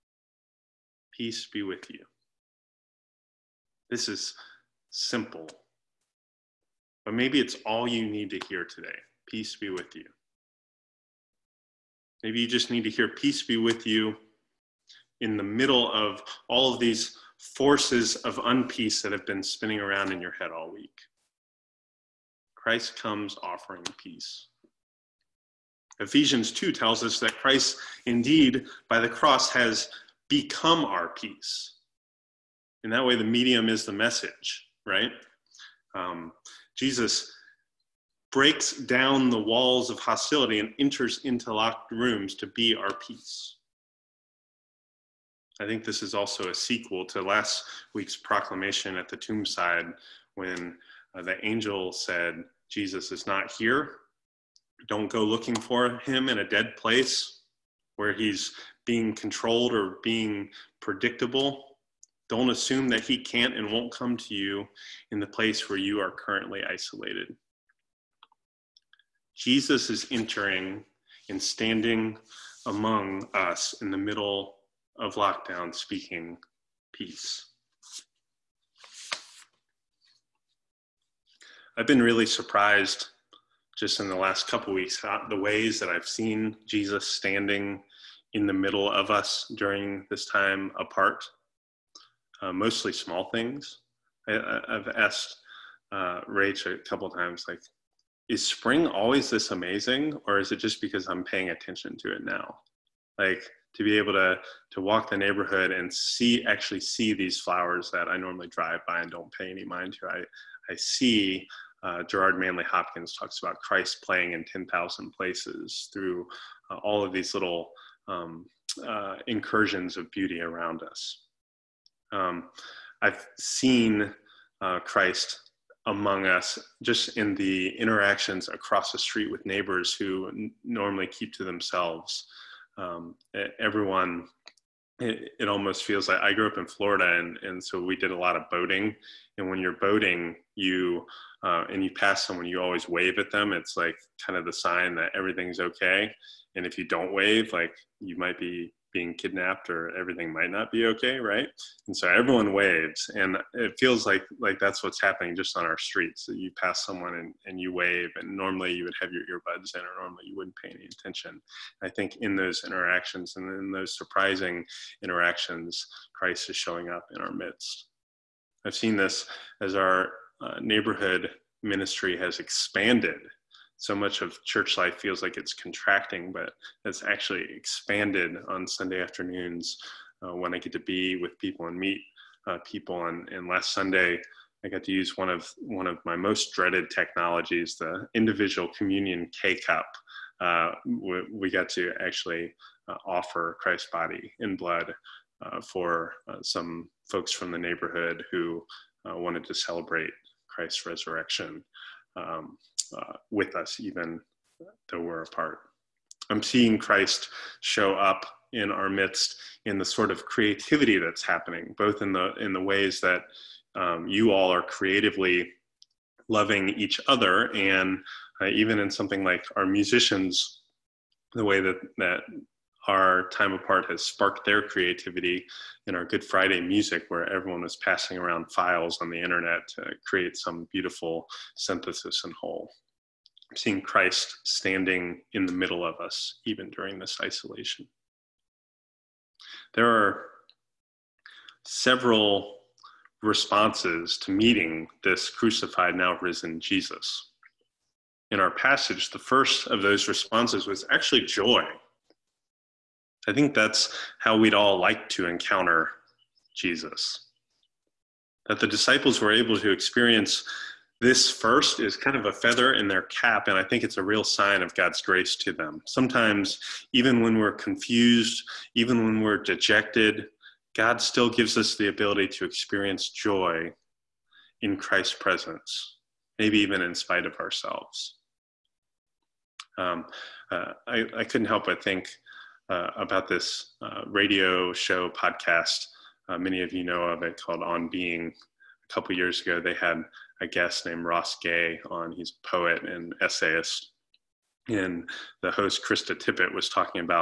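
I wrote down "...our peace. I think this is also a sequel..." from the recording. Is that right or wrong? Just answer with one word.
right.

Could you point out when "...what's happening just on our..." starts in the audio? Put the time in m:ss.
2:34.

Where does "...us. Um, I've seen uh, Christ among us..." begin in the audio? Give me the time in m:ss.
2:00.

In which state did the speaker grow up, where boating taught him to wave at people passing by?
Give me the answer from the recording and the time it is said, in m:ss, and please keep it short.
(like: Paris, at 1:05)
Florida, at 2:16.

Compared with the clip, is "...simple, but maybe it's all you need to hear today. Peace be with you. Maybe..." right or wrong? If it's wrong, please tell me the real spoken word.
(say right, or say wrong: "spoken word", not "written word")
right.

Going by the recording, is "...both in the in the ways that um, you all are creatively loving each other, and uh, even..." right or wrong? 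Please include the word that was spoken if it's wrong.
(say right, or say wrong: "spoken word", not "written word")
right.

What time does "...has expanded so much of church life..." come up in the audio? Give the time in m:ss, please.
2:52.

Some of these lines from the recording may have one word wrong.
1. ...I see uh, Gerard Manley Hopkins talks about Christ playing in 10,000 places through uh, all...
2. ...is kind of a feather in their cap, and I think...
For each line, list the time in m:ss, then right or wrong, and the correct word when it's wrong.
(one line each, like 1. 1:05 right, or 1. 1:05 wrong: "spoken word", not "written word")
1. 1:50 right
2. 4:21 right.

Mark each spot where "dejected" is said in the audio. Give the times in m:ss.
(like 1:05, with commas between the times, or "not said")
4:29.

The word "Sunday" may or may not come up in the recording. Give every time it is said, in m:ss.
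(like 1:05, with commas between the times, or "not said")
2:58, 3:03.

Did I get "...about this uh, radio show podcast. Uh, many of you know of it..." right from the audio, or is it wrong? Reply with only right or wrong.
right.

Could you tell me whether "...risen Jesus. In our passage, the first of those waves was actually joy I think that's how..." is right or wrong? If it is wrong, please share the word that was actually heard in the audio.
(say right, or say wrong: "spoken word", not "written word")
wrong: "responses", not "waves".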